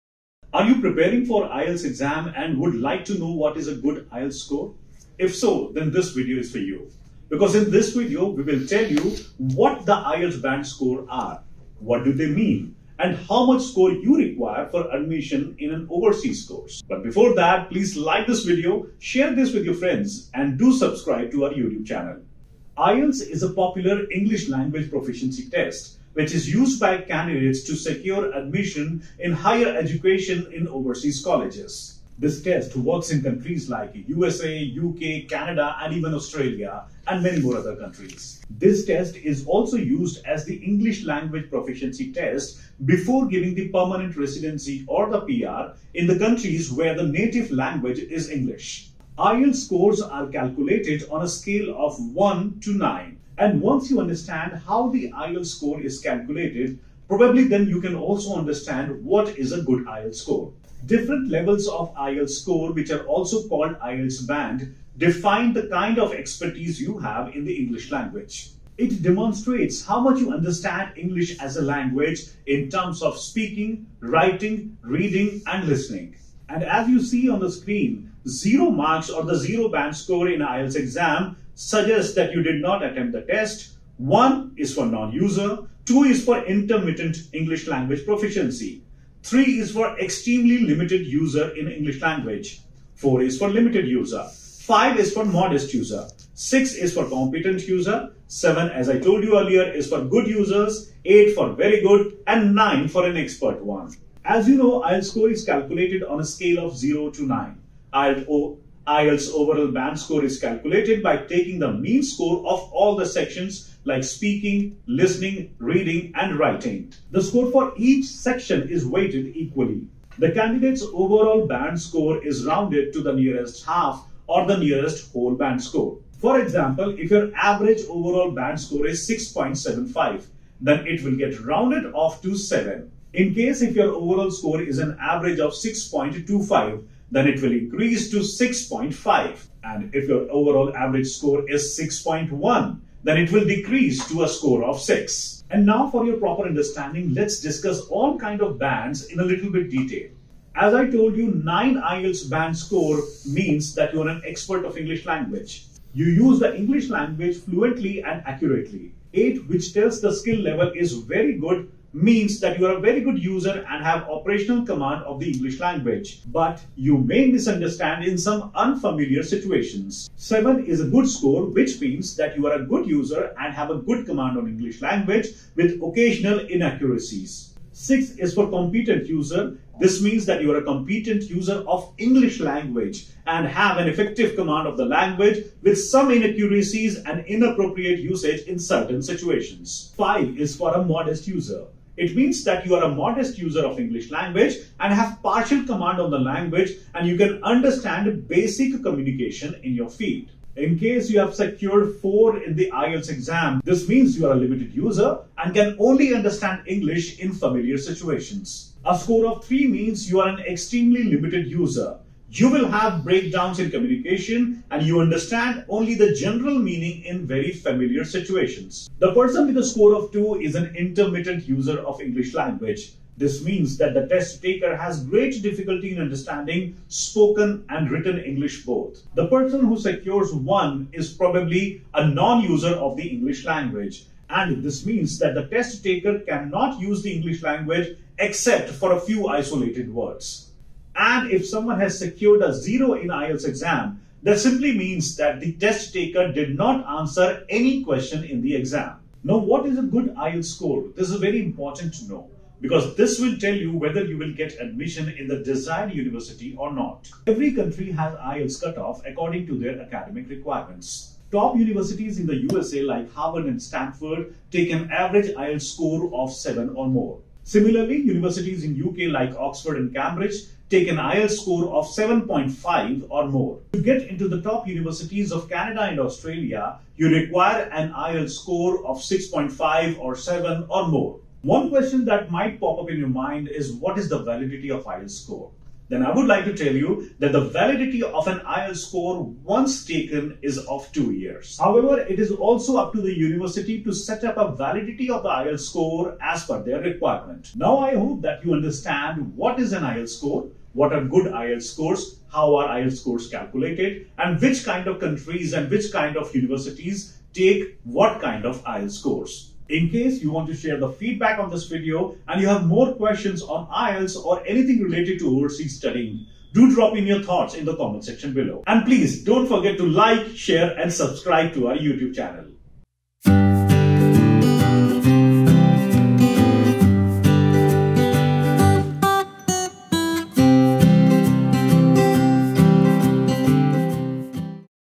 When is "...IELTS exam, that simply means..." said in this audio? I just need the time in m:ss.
4:03.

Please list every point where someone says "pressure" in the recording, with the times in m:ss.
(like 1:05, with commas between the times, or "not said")
not said.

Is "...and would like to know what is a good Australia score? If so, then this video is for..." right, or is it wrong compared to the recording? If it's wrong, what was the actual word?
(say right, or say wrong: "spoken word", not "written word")
wrong: "IELTS", not "Australia".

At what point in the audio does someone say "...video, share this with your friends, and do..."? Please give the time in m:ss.
0:18.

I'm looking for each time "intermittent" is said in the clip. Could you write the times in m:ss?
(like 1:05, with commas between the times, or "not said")
1:26, 3:40.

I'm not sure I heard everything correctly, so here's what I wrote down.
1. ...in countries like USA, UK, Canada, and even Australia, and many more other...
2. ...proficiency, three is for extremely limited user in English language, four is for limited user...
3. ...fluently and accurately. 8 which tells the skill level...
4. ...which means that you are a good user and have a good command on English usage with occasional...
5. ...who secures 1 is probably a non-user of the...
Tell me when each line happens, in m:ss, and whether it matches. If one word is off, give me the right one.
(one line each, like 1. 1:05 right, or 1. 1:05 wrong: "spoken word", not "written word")
1. 0:33 right
2. 1:28 right
3. 2:37 right
4. 2:51 wrong: "language", not "usage"
5. 3:49 right.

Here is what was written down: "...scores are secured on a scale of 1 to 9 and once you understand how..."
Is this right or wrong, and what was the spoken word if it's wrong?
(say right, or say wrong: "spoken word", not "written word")
wrong: "calculated", not "secured".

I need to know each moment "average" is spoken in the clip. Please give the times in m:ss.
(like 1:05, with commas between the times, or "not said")
2:07, 2:14, 2:20, 4:24.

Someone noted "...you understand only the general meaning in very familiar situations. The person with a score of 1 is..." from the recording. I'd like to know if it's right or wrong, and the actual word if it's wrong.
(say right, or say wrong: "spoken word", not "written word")
wrong: "2", not "1".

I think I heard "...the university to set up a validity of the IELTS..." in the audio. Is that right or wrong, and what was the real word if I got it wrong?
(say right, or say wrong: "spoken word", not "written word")
right.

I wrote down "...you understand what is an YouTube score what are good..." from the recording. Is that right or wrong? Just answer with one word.
wrong.